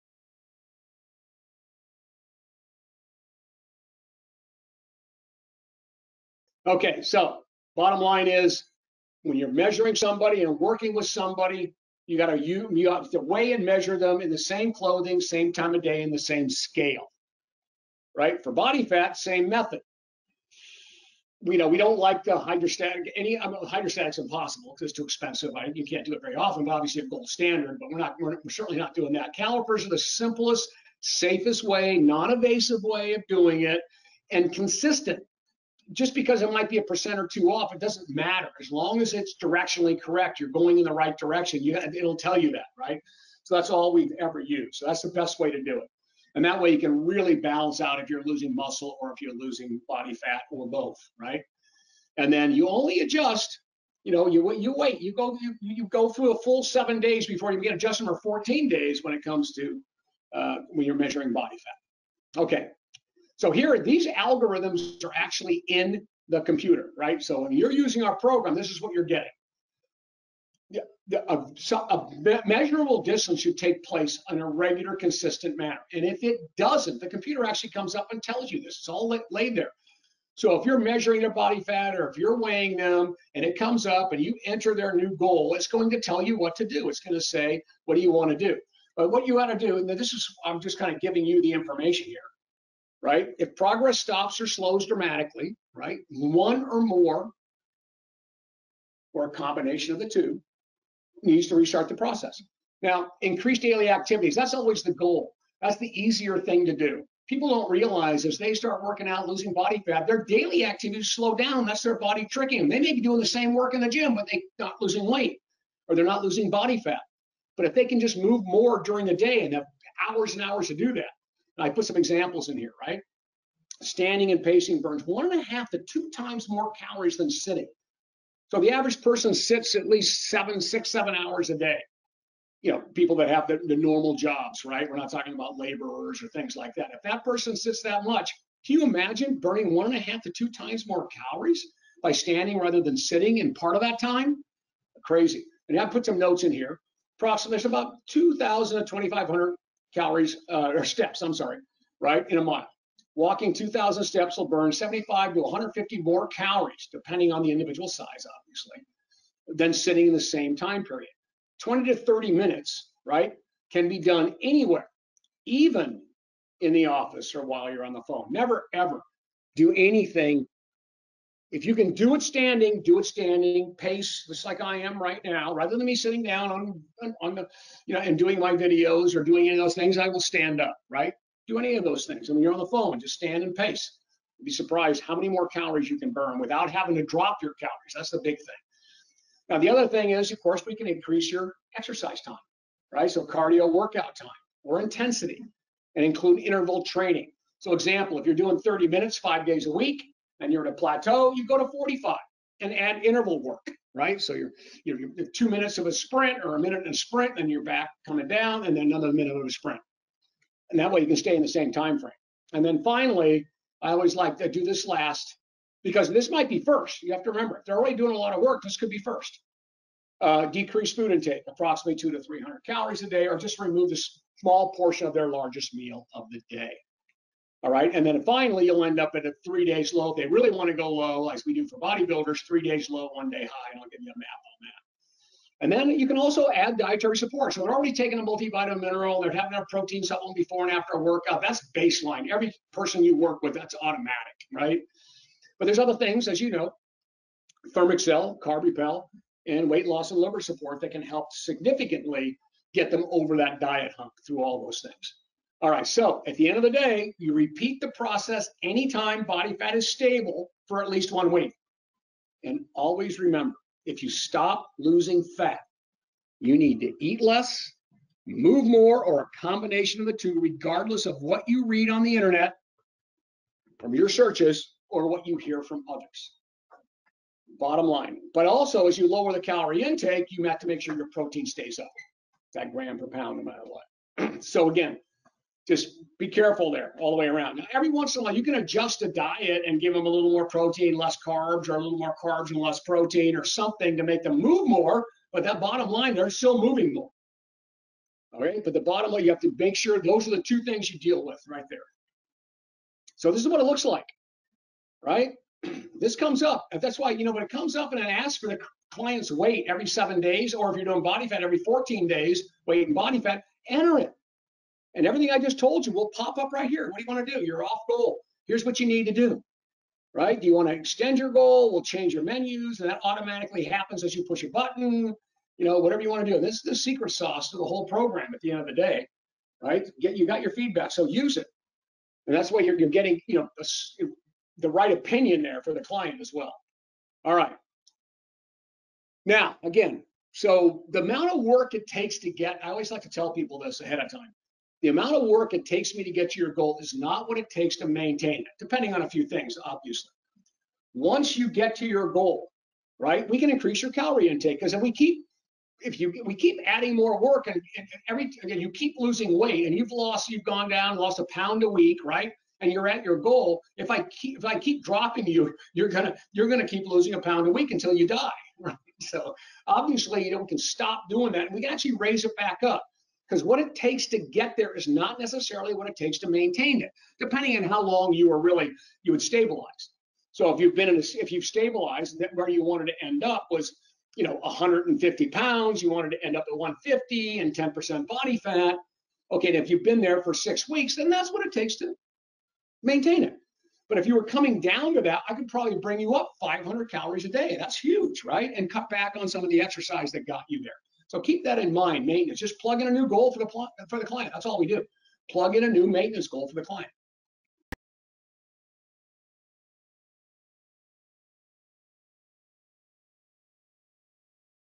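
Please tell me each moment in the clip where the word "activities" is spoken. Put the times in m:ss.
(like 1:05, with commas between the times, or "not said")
1:43, 1:50.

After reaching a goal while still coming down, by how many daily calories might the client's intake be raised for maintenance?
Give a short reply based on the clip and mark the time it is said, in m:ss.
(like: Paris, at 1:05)
500, at 6:36.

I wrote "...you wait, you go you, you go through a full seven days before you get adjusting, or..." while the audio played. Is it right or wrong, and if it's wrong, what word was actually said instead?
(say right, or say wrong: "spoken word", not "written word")
right.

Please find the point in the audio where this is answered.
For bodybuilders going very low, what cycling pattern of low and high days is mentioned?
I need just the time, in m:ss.
3:52.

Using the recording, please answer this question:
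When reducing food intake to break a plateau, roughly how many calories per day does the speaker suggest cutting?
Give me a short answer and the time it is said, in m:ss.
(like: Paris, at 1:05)
200 to 300, at 3:41.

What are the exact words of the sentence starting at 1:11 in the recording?
A, a measurable distance should take place in a regular, consistent manner.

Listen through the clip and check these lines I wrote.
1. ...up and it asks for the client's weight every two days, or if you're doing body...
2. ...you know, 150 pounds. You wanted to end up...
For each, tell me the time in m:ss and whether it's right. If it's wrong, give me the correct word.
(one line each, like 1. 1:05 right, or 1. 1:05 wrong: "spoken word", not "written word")
1. 5:07 wrong: "seven", not "two"
2. 6:24 right.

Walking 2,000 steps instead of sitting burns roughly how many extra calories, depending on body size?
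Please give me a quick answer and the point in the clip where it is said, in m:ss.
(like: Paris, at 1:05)
75 to 150, at 2:34.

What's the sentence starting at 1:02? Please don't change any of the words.
Okay, so here, these algorithms are actually in the computer, right?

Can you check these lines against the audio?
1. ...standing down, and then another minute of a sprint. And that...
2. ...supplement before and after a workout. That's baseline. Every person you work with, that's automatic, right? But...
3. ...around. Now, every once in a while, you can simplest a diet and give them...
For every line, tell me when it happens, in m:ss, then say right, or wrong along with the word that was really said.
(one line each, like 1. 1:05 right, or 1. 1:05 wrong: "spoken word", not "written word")
1. 3:28 wrong: "coming", not "standing"
2. 4:00 right
3. 4:47 wrong: "adjust", not "simplest".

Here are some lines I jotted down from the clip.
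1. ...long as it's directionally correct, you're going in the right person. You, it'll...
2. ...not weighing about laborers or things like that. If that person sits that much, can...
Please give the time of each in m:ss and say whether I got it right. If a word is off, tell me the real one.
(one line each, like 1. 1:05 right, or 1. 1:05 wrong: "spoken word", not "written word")
1. 0:38 wrong: "direction", not "person"
2. 2:14 wrong: "talking", not "weighing".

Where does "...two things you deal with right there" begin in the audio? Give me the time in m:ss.
5:00.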